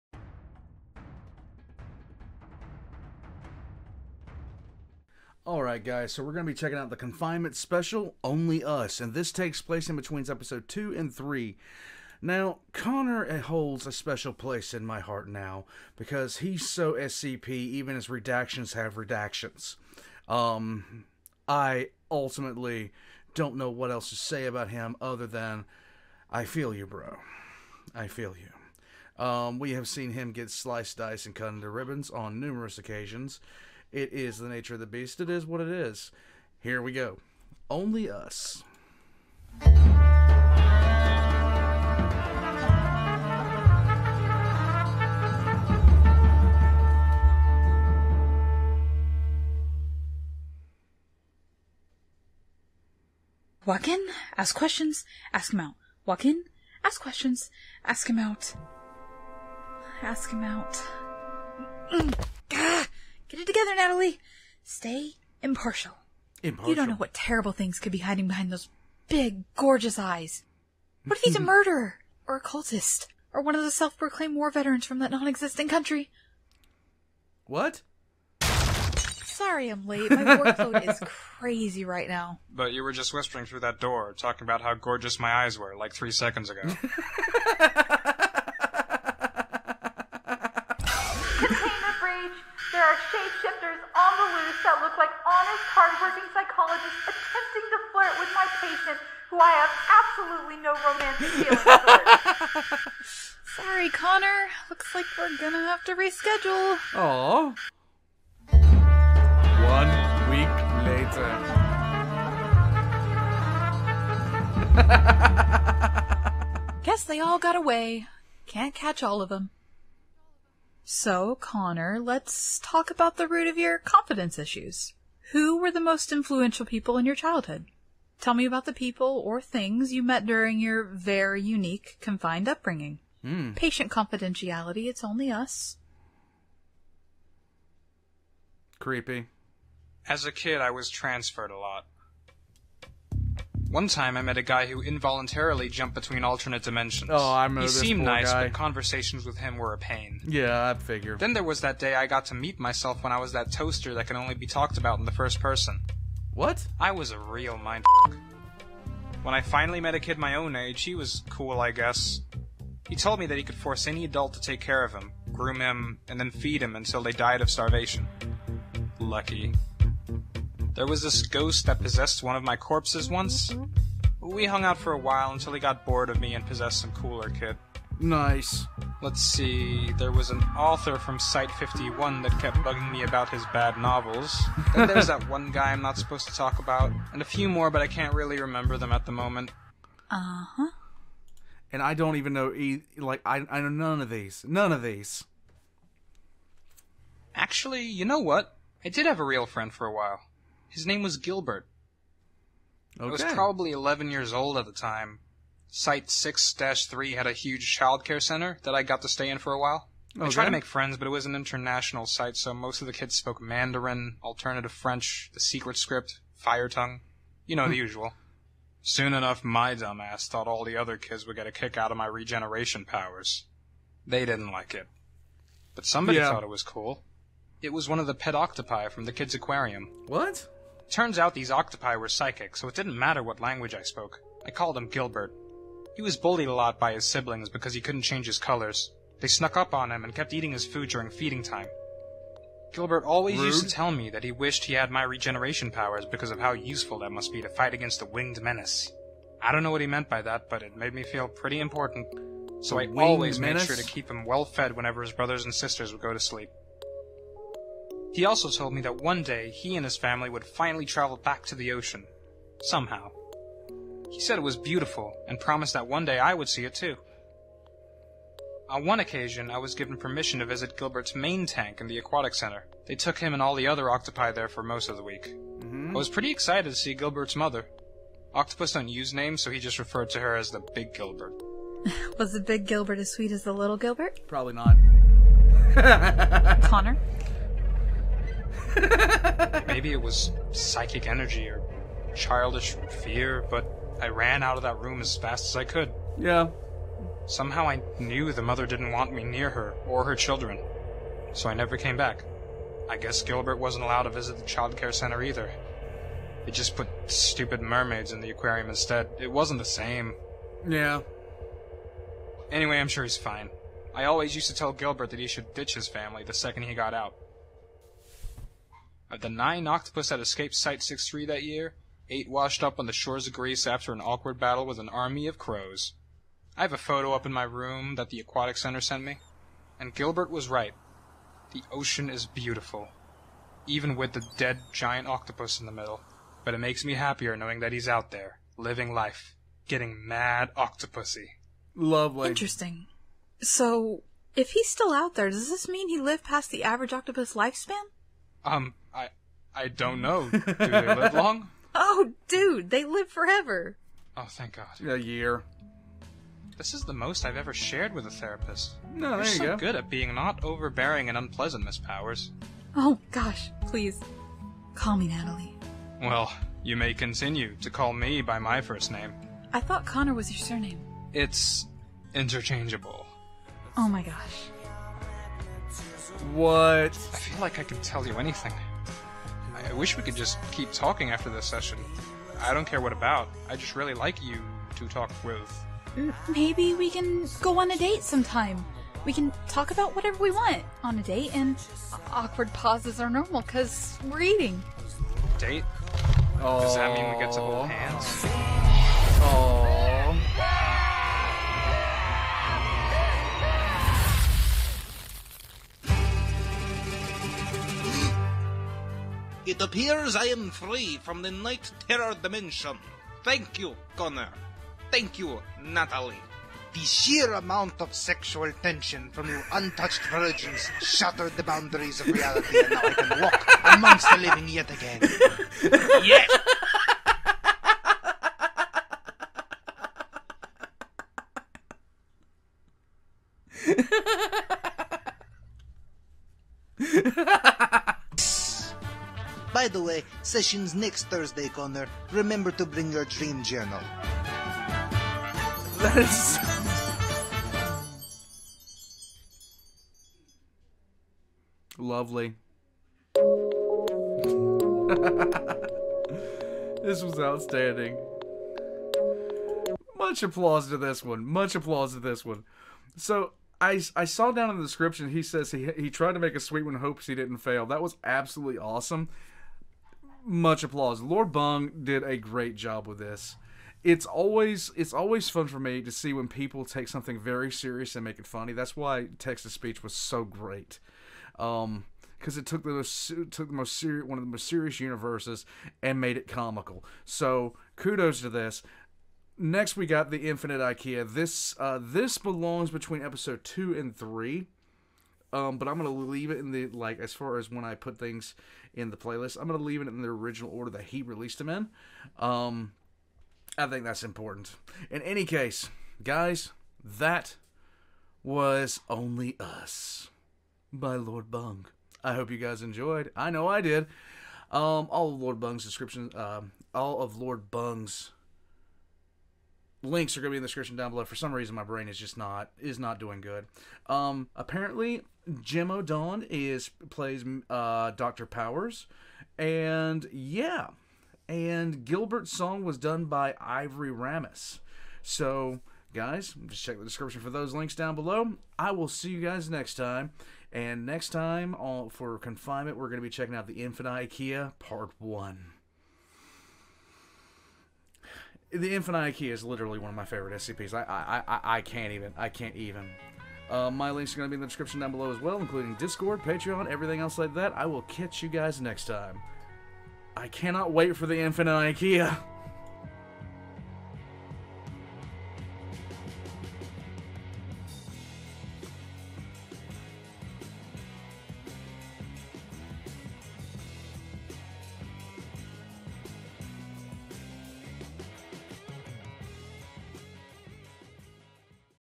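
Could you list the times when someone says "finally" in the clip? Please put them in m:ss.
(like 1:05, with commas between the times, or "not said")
2:39, 4:20.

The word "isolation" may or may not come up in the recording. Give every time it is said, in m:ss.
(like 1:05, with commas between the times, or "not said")
not said.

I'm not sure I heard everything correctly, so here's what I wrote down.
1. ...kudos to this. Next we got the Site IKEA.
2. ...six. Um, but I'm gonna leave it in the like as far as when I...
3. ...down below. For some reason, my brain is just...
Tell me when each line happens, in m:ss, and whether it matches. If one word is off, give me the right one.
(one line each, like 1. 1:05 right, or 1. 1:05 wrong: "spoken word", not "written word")
1. 8:07 wrong: "Infinite", not "Site"
2. 8:13 wrong: "three", not "six"
3. 8:40 right.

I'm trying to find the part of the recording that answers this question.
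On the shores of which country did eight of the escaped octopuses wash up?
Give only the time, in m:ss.
5:23.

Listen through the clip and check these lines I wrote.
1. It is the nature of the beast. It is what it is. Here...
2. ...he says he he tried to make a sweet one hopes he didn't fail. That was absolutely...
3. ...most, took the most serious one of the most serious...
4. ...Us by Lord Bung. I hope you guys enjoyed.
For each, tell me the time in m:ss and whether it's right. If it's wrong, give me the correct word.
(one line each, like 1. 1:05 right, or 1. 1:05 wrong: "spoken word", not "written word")
1. 0:33 right
2. 7:45 right
3. 8:02 right
4. 8:29 right.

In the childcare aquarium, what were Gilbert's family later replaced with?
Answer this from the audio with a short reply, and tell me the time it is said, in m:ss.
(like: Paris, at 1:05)
Mermaids, at 5:07.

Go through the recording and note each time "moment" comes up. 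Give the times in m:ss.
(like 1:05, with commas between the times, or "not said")
3:09.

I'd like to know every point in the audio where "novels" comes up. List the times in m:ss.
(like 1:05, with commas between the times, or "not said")
3:03.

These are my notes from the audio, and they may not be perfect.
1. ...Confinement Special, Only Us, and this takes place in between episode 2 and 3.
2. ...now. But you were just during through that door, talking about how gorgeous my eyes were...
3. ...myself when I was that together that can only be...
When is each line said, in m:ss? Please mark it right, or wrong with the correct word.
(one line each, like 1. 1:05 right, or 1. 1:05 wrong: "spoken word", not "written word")
1. 0:06 right
2. 1:22 wrong: "whispering", not "during"
3. 2:32 wrong: "toaster", not "together".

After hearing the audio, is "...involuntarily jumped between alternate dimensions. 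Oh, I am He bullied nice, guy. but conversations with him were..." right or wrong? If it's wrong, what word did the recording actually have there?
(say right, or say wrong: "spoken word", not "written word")
wrong: "seemed", not "bullied".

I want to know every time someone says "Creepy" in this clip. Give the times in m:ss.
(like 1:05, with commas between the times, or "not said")
2:18.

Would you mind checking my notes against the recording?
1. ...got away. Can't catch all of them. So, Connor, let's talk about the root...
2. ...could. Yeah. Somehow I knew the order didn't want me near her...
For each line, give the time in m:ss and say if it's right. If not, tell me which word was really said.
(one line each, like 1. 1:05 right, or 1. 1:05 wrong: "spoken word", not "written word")
1. 1:57 right
2. 4:55 wrong: "mother", not "order".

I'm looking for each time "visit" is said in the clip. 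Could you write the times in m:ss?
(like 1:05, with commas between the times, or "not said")
4:30, 5:04.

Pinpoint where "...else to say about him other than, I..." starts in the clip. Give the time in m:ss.
0:23.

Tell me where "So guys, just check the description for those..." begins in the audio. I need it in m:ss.
8:55.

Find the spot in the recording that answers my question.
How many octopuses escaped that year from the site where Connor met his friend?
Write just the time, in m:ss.
5:19.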